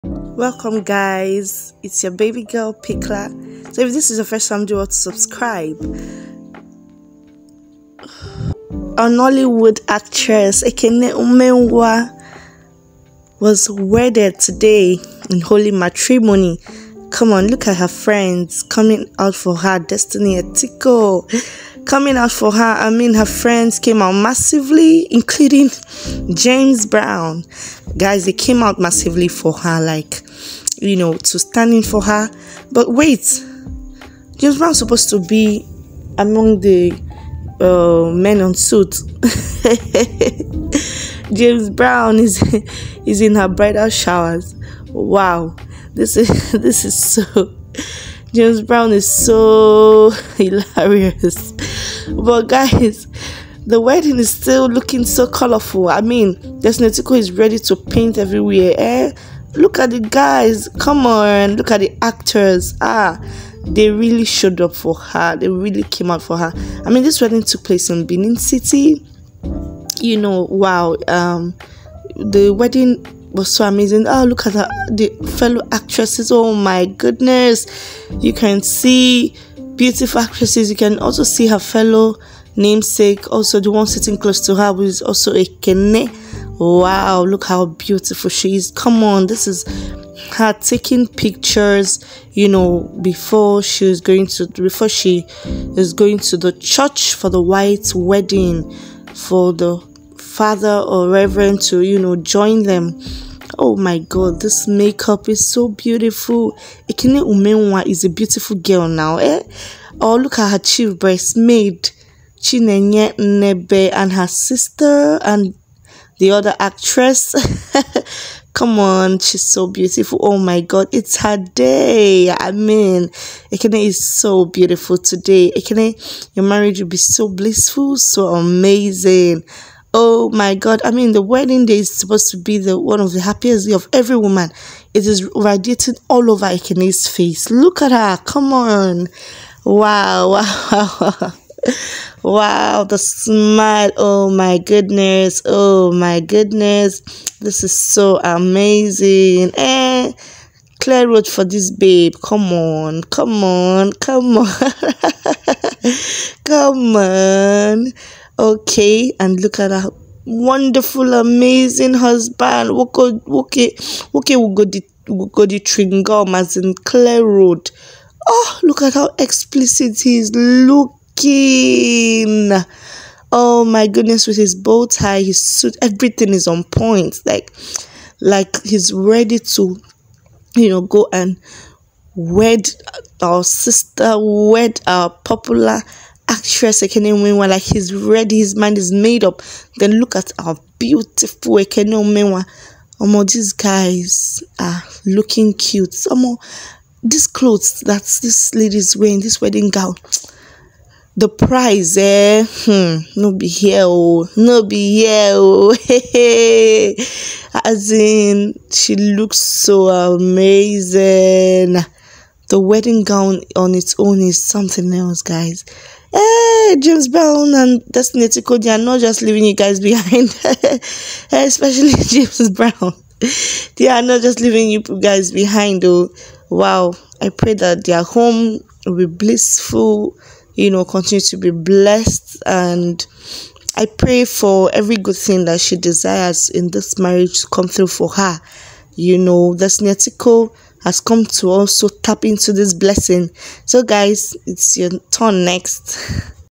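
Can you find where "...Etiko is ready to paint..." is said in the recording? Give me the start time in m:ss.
0:56.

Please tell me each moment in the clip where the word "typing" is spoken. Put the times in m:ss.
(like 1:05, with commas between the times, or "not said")
not said.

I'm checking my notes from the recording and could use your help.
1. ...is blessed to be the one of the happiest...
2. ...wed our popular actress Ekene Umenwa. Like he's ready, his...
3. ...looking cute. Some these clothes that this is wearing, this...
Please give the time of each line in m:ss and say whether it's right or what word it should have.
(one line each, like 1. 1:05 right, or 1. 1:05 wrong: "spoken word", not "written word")
1. 2:11 wrong: "supposed", not "blessed"
2. 3:04 right
3. 3:15 right.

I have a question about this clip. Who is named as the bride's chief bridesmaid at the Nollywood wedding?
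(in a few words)
Chinenye Nnebe.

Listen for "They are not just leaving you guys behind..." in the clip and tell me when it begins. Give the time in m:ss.
3:43.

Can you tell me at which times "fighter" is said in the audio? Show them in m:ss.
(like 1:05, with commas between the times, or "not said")
not said.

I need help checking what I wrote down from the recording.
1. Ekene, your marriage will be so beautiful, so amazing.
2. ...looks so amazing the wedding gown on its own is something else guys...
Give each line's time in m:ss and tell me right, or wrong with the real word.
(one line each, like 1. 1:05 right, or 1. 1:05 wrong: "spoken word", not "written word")
1. 2:05 wrong: "blissful", not "beautiful"
2. 3:28 right.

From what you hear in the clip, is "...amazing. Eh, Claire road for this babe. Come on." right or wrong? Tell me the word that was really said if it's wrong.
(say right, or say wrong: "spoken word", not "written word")
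right.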